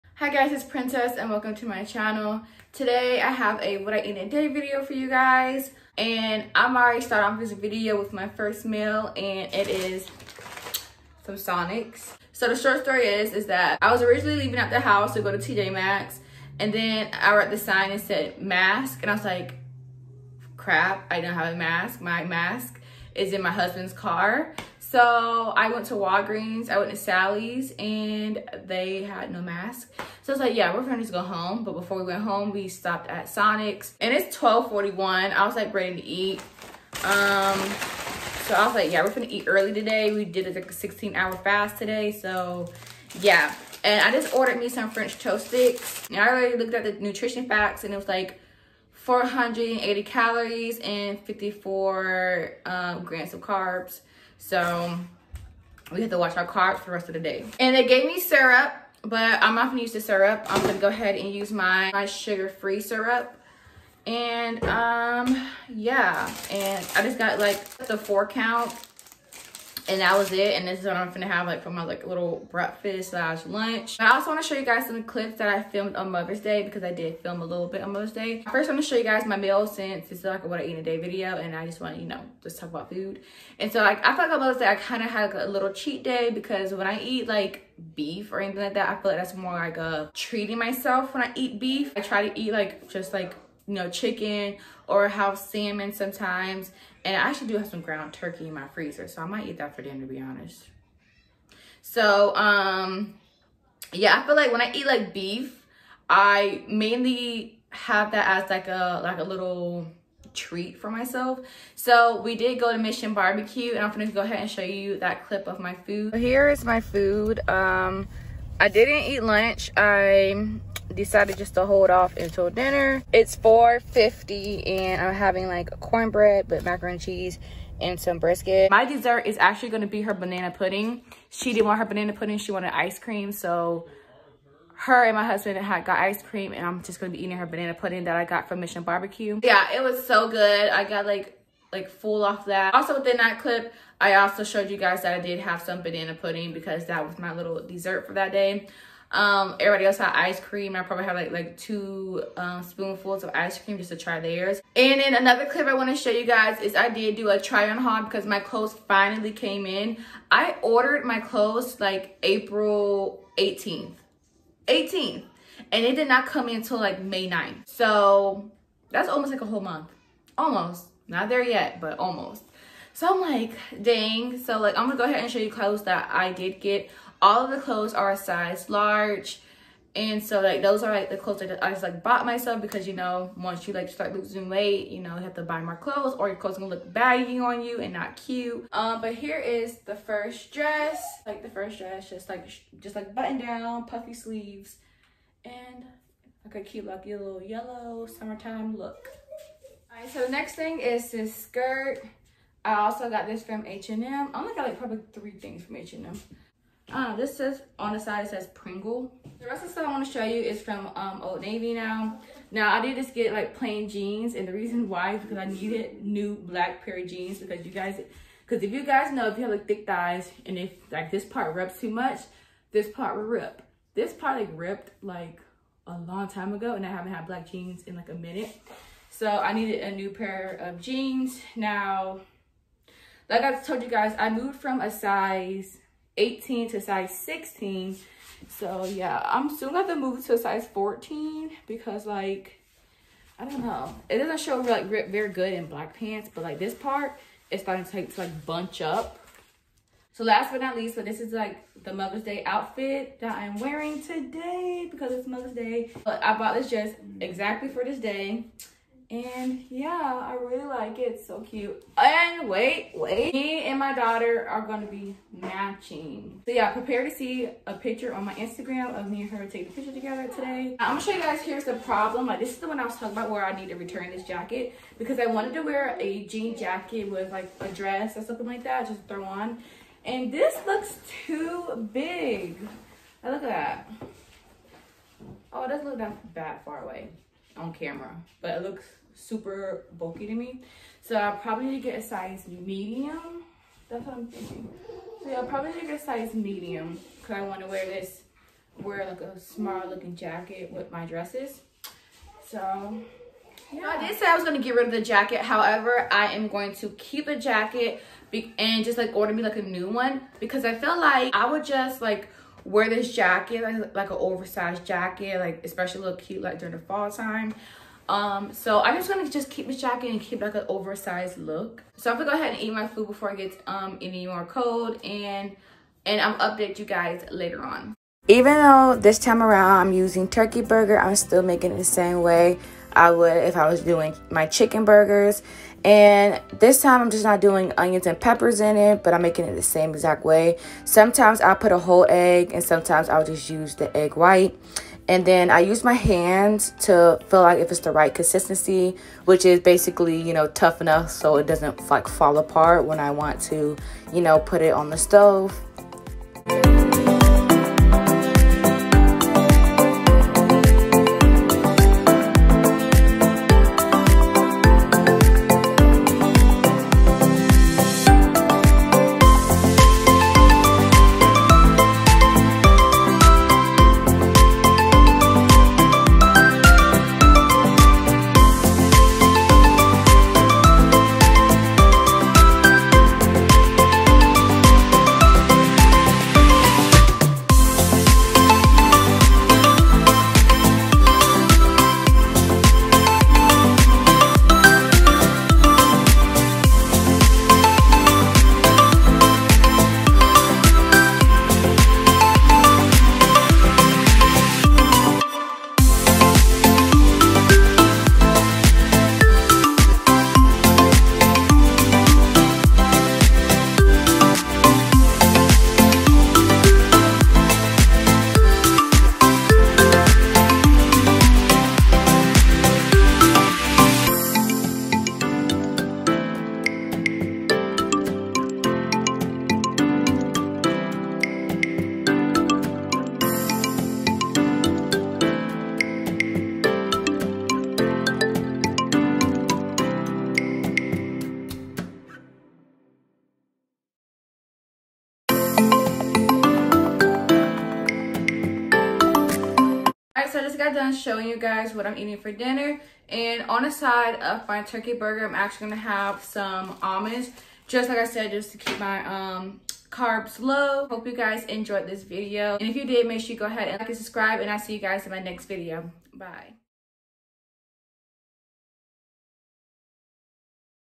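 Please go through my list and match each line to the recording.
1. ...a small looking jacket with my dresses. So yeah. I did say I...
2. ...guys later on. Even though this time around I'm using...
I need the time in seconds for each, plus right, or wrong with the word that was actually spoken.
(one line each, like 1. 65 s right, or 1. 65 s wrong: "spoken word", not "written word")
1. 299 s right
2. 326 s right.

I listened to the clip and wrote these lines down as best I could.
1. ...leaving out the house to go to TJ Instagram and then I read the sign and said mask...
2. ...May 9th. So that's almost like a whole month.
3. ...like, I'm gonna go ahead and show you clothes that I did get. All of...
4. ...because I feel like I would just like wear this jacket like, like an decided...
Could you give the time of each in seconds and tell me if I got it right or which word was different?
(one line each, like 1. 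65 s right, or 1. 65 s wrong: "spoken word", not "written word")
1. 14 s wrong: "Maxx", not "Instagram"
2. 167 s right
3. 174 s right
4. 310 s wrong: "oversized", not "decided".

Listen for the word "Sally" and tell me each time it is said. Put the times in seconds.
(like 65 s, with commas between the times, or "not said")
26 s.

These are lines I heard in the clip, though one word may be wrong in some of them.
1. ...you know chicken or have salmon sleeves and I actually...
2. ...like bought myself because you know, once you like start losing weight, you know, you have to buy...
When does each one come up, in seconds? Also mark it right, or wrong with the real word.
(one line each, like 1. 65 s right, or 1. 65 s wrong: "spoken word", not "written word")
1. 93 s wrong: "sometimes", not "sleeves"
2. 181 s right.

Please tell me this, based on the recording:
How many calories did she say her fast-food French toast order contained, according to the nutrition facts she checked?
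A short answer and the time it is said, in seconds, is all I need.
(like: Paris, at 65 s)
480, at 48 s.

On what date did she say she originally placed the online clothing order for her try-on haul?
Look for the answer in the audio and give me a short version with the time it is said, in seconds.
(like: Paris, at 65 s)
April 18th, at 162 s.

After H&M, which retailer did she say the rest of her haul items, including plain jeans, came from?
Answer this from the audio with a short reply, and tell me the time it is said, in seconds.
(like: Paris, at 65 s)
Old Navy, at 211 s.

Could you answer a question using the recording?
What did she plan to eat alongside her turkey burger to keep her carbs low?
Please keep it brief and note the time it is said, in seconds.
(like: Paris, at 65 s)
almonds, at 456 s.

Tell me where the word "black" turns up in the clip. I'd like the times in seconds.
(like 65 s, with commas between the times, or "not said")
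216 s, 227 s, 245 s.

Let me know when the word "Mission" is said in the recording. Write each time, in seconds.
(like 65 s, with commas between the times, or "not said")
112 s, 138 s.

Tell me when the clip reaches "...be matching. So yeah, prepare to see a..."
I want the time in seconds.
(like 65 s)
264 s.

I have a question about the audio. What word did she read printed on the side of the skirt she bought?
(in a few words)
Pringle.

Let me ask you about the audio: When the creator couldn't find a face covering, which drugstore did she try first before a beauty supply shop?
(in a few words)
Walgreens.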